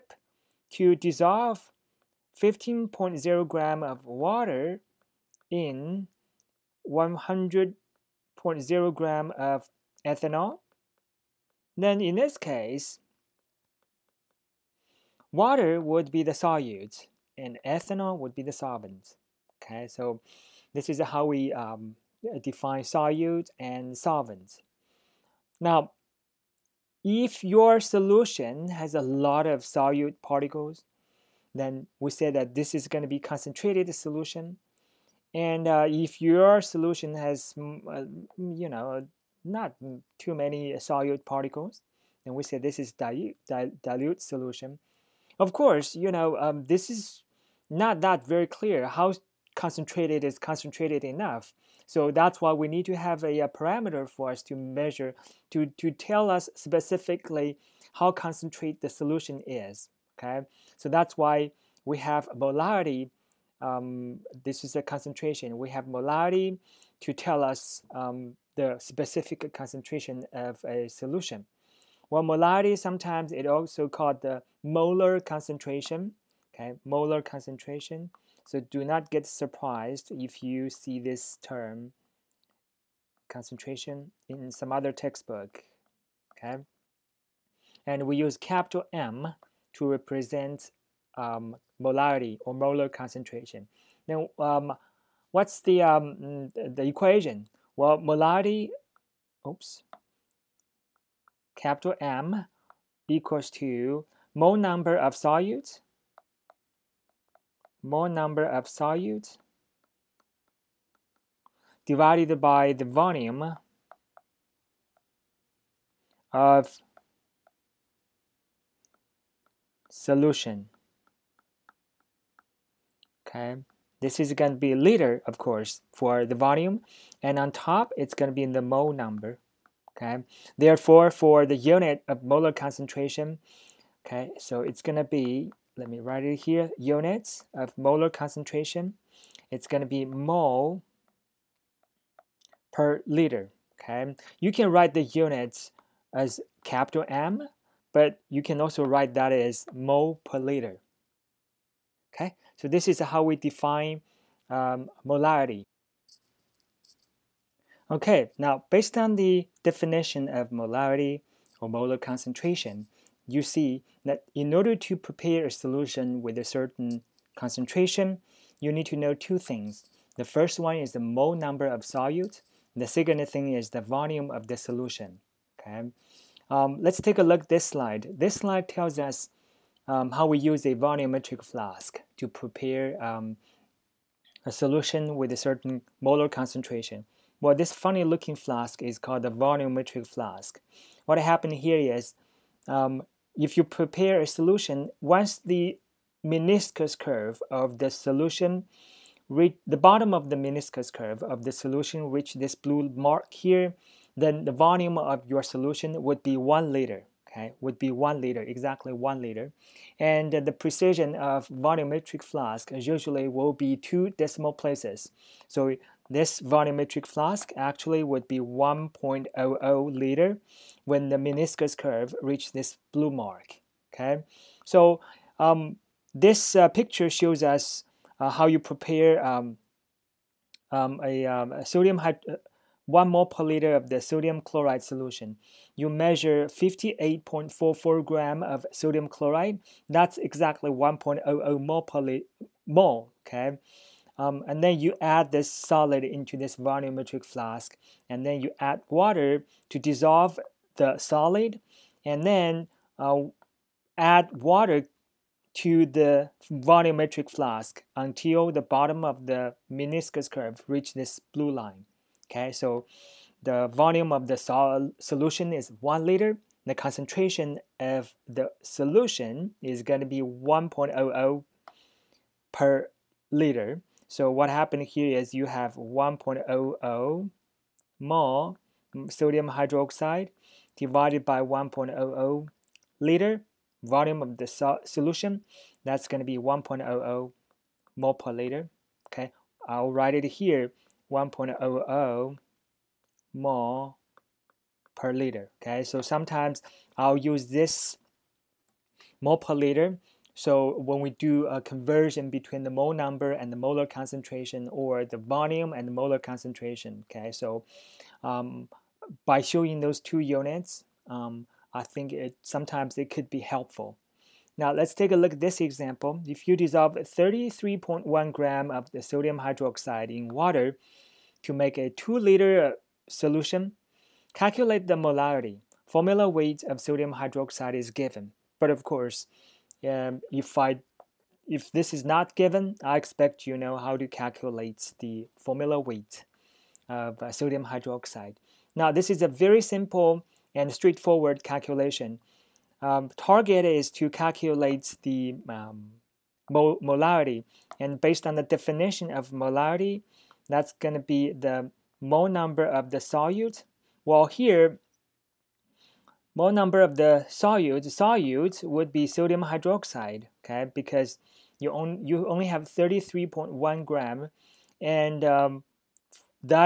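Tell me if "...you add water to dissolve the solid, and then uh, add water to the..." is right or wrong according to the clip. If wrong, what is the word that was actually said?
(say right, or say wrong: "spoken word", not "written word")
right.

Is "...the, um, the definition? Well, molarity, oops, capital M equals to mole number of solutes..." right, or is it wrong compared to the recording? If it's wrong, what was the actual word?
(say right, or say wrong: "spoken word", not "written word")
wrong: "equation", not "definition".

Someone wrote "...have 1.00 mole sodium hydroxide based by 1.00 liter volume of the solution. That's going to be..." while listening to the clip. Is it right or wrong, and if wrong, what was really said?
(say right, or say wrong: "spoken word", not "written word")
wrong: "divided", not "based".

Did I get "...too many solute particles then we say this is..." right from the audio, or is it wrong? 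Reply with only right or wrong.
right.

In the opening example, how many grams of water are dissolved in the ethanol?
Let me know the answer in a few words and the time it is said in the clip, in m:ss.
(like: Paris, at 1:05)
15.0 grams, at 0:02.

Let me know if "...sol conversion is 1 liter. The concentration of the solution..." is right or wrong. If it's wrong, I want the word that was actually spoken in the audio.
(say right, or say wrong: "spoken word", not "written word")
wrong: "solution", not "conversion".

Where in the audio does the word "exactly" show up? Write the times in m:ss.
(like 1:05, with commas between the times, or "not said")
3:28, 4:00.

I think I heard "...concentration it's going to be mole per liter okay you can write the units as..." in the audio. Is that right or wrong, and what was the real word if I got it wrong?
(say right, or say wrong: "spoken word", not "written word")
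right.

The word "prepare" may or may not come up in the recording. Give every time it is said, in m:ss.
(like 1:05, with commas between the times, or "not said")
2:44, 3:02, 3:13, 3:48.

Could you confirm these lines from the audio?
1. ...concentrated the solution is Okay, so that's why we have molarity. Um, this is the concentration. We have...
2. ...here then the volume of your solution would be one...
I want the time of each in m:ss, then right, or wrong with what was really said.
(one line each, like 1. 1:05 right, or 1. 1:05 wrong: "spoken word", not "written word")
1. 0:58 right
2. 3:23 right.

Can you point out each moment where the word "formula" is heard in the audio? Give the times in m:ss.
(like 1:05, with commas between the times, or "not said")
5:25, 5:35.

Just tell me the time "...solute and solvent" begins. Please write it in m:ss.
0:22.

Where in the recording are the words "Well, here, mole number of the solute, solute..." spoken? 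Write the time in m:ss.
5:54.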